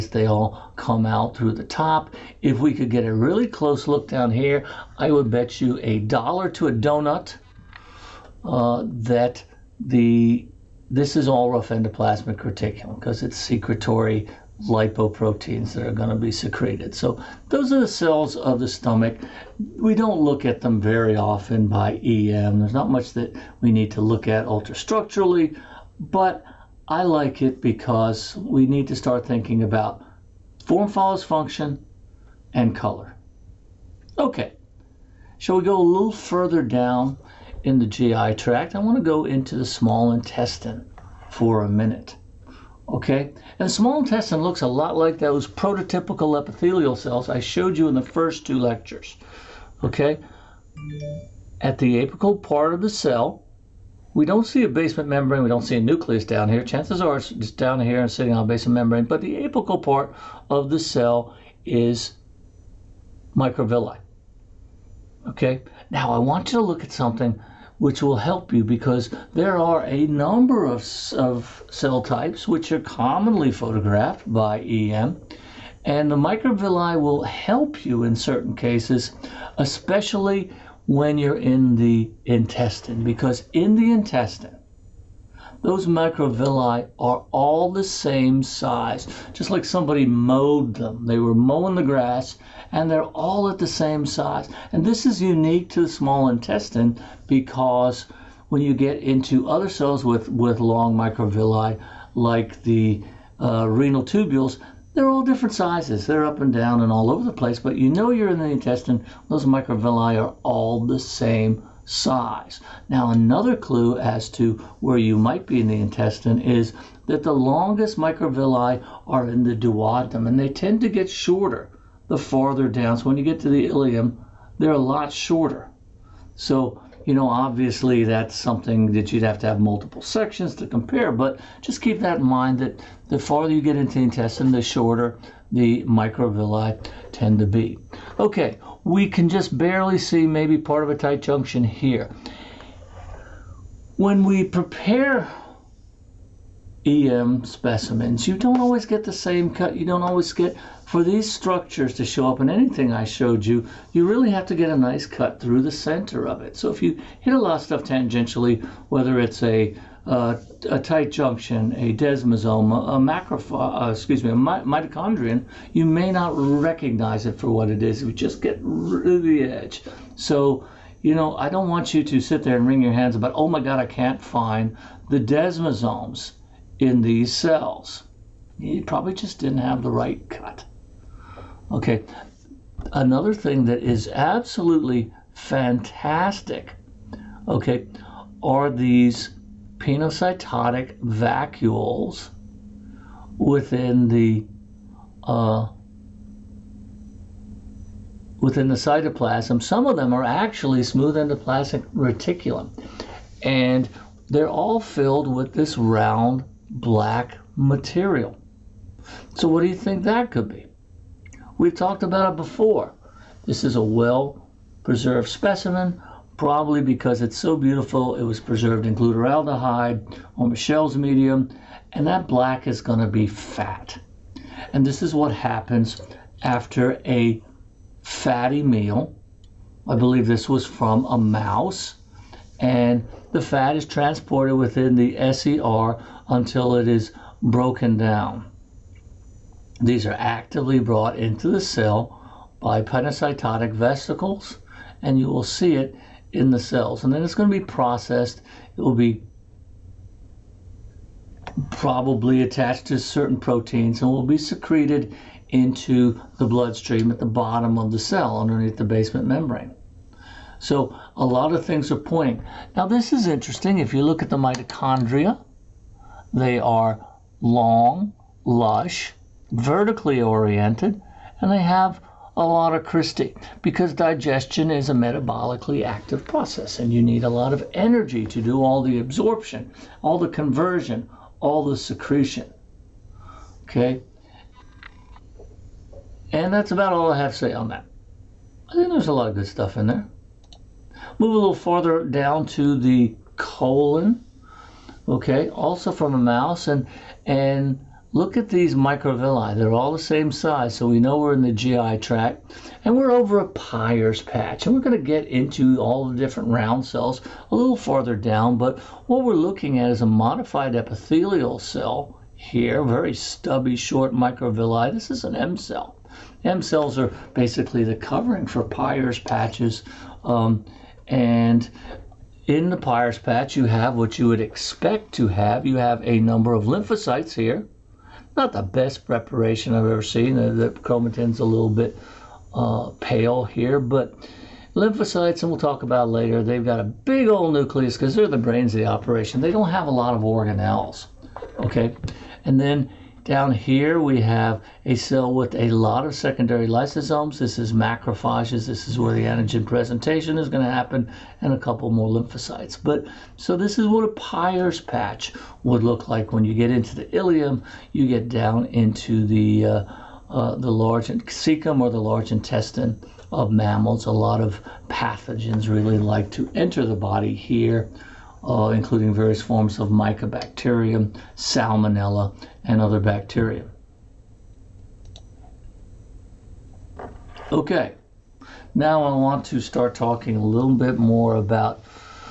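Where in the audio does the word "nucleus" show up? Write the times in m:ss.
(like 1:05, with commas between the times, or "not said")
0:55, 5:37.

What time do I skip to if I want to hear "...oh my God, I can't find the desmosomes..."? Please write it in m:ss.
2:53.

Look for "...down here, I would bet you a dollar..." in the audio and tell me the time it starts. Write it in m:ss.
0:04.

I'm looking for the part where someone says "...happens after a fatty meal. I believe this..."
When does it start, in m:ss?
3:45.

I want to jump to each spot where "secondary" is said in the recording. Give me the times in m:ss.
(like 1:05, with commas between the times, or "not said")
5:46.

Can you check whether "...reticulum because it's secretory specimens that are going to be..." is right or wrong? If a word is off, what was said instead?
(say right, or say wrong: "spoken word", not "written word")
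wrong: "lipoproteins", not "specimens".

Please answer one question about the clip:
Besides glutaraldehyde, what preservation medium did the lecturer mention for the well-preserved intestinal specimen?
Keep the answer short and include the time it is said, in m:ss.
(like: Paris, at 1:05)
Michelle's medium, at 3:40.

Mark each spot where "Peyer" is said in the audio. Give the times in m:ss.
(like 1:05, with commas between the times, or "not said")
5:03, 5:18, 5:22, 5:54.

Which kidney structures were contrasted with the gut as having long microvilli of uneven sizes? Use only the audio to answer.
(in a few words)
renal tubules.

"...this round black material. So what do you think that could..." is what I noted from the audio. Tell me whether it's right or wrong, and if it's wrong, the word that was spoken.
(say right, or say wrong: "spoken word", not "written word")
right.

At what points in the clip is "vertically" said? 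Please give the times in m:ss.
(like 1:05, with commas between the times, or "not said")
4:29.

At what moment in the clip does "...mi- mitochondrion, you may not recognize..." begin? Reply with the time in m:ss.
2:44.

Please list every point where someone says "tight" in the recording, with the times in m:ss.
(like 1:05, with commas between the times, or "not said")
2:20, 2:40.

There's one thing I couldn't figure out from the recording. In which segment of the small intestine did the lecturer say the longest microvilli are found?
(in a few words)
duodenum.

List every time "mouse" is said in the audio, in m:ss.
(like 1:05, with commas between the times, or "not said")
3:51, 4:56.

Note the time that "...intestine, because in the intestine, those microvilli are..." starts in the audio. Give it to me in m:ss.
1:22.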